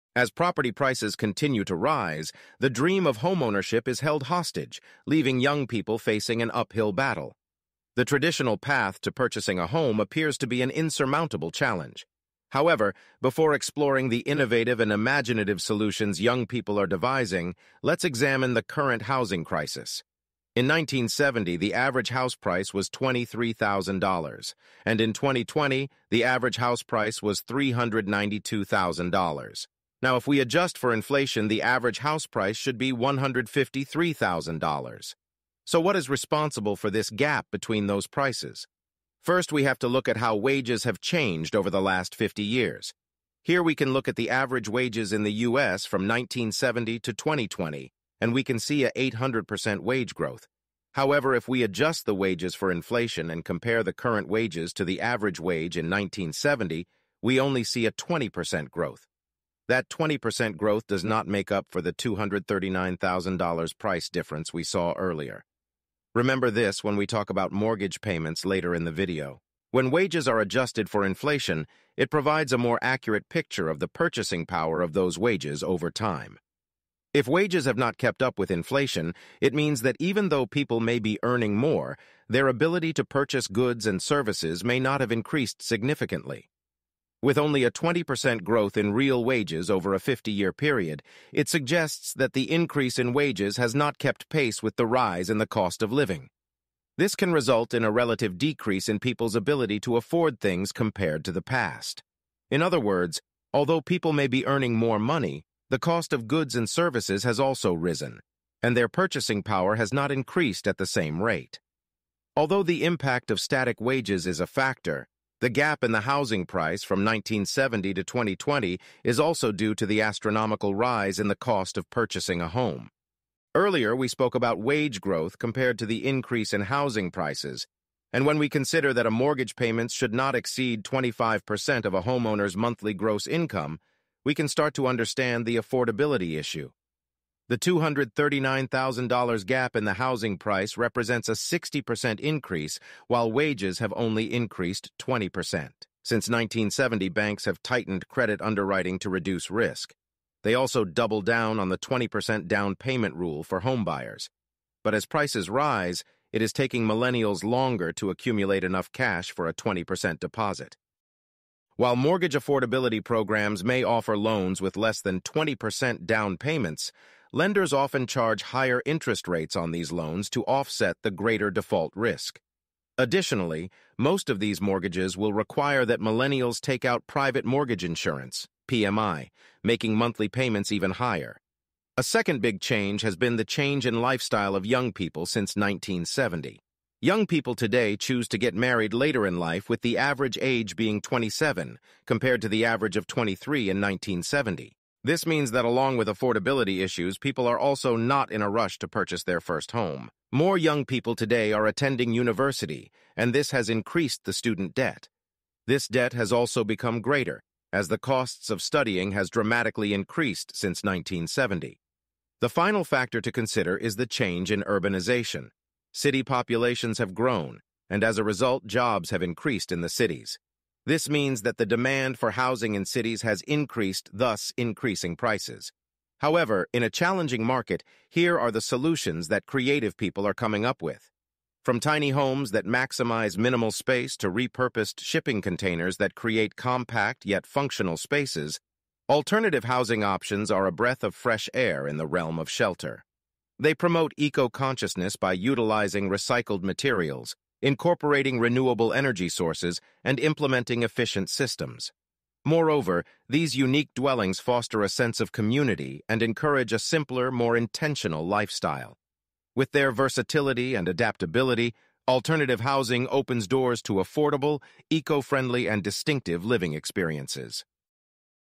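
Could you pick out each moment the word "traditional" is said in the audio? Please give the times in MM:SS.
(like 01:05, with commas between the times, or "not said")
00:08.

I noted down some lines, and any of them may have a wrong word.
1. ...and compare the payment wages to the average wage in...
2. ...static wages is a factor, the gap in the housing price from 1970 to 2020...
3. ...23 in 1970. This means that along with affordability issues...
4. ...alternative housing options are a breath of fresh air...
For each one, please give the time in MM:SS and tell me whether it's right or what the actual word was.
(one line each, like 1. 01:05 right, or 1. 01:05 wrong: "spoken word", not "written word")
1. 00:53 wrong: "current", not "payment"
2. 01:53 right
3. 03:13 right
4. 03:59 right.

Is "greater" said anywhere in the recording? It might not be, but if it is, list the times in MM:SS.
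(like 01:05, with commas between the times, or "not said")
02:51, 03:27.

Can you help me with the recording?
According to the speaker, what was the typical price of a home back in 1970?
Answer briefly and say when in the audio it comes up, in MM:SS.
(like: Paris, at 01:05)
$23,000, at 00:22.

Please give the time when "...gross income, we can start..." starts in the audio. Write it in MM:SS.
02:12.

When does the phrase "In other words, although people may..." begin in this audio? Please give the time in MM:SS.
01:42.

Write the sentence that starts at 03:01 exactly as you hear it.
A second big change has been the change in lifestyle of young people since 1970.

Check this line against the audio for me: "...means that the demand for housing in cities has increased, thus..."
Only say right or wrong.
right.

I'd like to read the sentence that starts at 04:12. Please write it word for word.
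Moreover, these unique dwellings foster a sense of community and encourage a simpler, more intentional lifestyle.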